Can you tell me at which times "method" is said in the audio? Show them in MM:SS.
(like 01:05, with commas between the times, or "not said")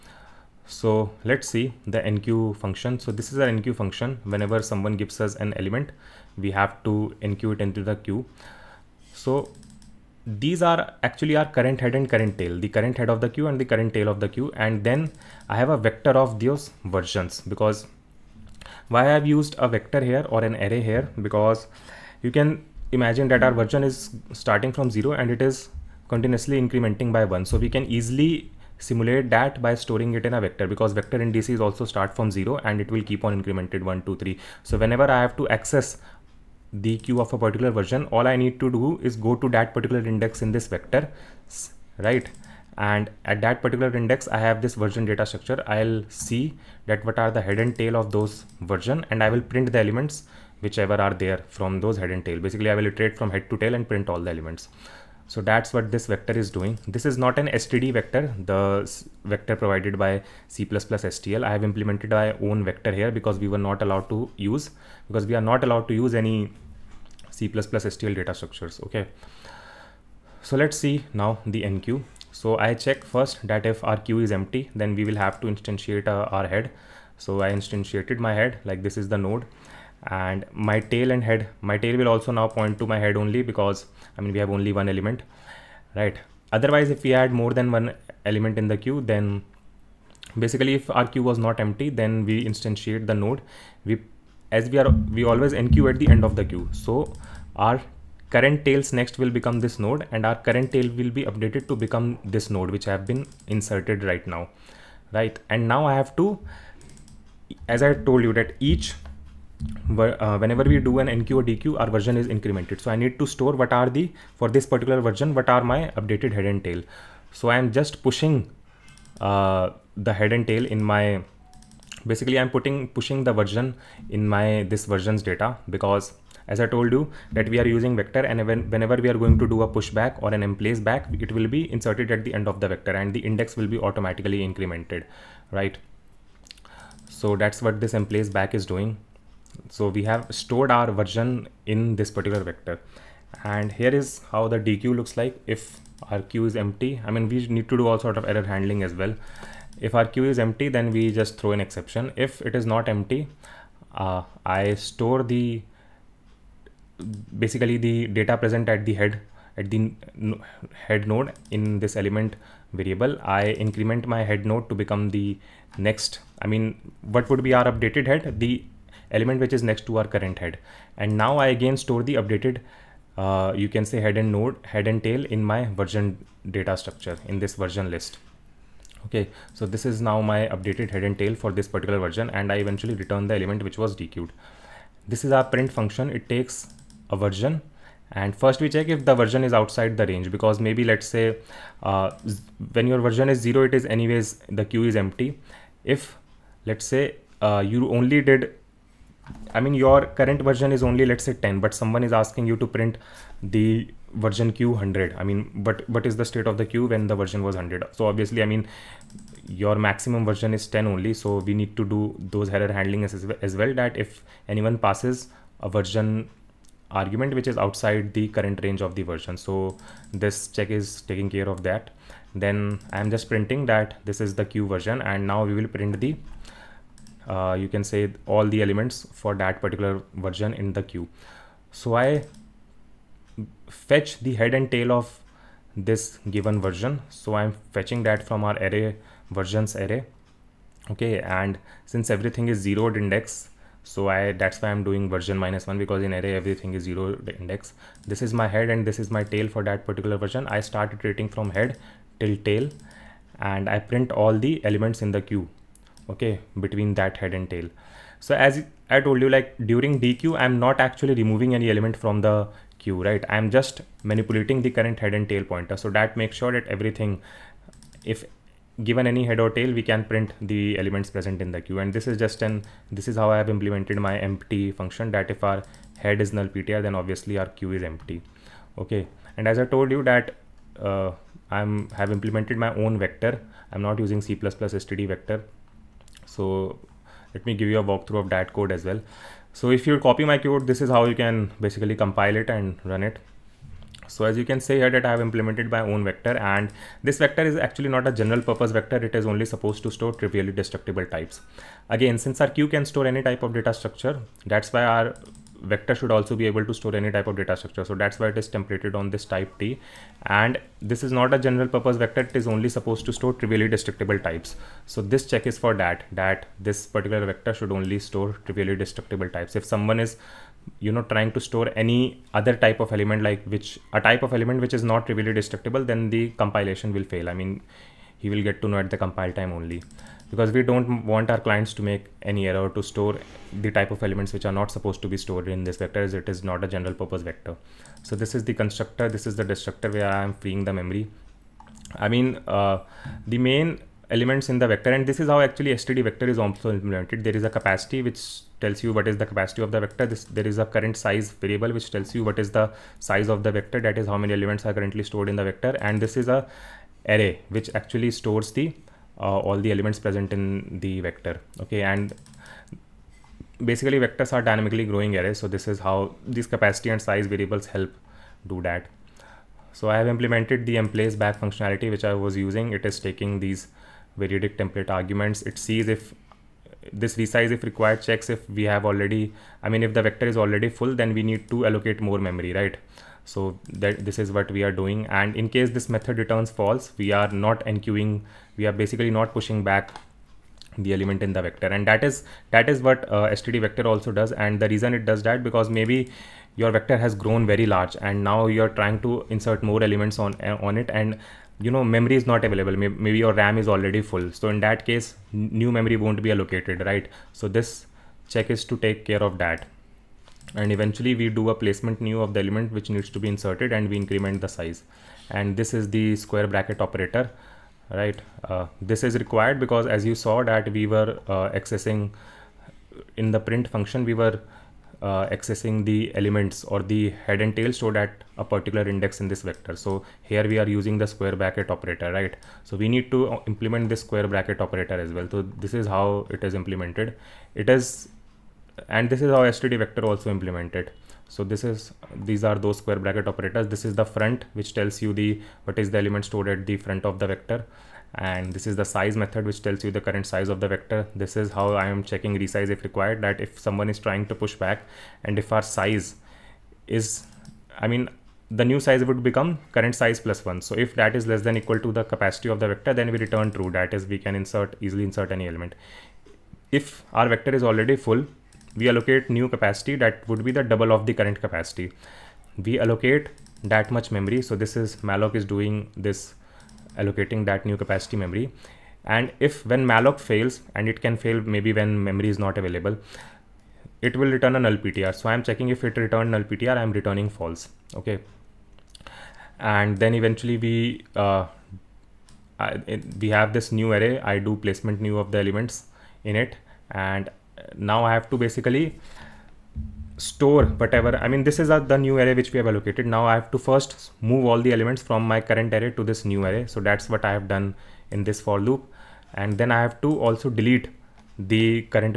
06:25, 07:29.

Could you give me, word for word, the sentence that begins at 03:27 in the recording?
So obviously, I mean, your maximum version is 10 only.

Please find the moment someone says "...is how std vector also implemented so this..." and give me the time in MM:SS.
07:19.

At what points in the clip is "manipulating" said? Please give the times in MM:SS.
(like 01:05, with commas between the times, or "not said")
04:24.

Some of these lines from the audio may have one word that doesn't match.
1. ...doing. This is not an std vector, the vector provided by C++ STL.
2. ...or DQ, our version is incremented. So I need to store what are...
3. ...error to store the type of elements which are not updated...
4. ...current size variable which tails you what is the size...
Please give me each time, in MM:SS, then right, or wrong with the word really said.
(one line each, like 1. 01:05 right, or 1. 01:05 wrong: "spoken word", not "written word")
1. 00:56 right
2. 01:51 right
3. 05:32 wrong: "supposed", not "updated"
4. 05:50 wrong: "tells", not "tails".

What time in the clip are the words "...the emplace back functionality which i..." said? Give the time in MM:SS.
06:10.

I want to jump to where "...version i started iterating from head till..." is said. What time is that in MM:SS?
04:10.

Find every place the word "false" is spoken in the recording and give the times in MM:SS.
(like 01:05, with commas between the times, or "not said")
06:26, 08:07.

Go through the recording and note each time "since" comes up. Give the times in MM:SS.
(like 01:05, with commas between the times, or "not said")
04:01, 05:02.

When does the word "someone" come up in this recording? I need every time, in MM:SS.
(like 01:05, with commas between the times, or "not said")
00:04, 03:21, 05:19, 07:33.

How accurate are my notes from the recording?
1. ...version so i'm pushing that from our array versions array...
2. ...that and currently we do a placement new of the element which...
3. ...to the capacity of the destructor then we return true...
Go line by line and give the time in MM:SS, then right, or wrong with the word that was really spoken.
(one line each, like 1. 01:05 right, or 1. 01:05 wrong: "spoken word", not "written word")
1. 03:56 wrong: "fetching", not "pushing"
2. 06:49 wrong: "eventually", not "currently"
3. 07:41 wrong: "vector", not "destructor".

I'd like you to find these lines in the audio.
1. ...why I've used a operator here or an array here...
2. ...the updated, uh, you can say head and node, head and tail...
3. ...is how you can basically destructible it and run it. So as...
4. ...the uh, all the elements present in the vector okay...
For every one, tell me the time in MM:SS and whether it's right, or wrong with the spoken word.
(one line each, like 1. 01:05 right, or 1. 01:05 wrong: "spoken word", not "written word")
1. 00:18 wrong: "vector", not "operator"
2. 02:52 right
3. 04:50 wrong: "compile", not "destructible"
4. 05:58 right.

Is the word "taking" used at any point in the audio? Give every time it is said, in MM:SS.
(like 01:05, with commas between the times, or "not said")
03:41, 06:12.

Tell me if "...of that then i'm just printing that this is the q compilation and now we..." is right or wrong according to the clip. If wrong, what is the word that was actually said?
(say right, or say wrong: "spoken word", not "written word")
wrong: "version", not "compilation".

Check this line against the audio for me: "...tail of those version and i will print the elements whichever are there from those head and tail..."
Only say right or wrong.
right.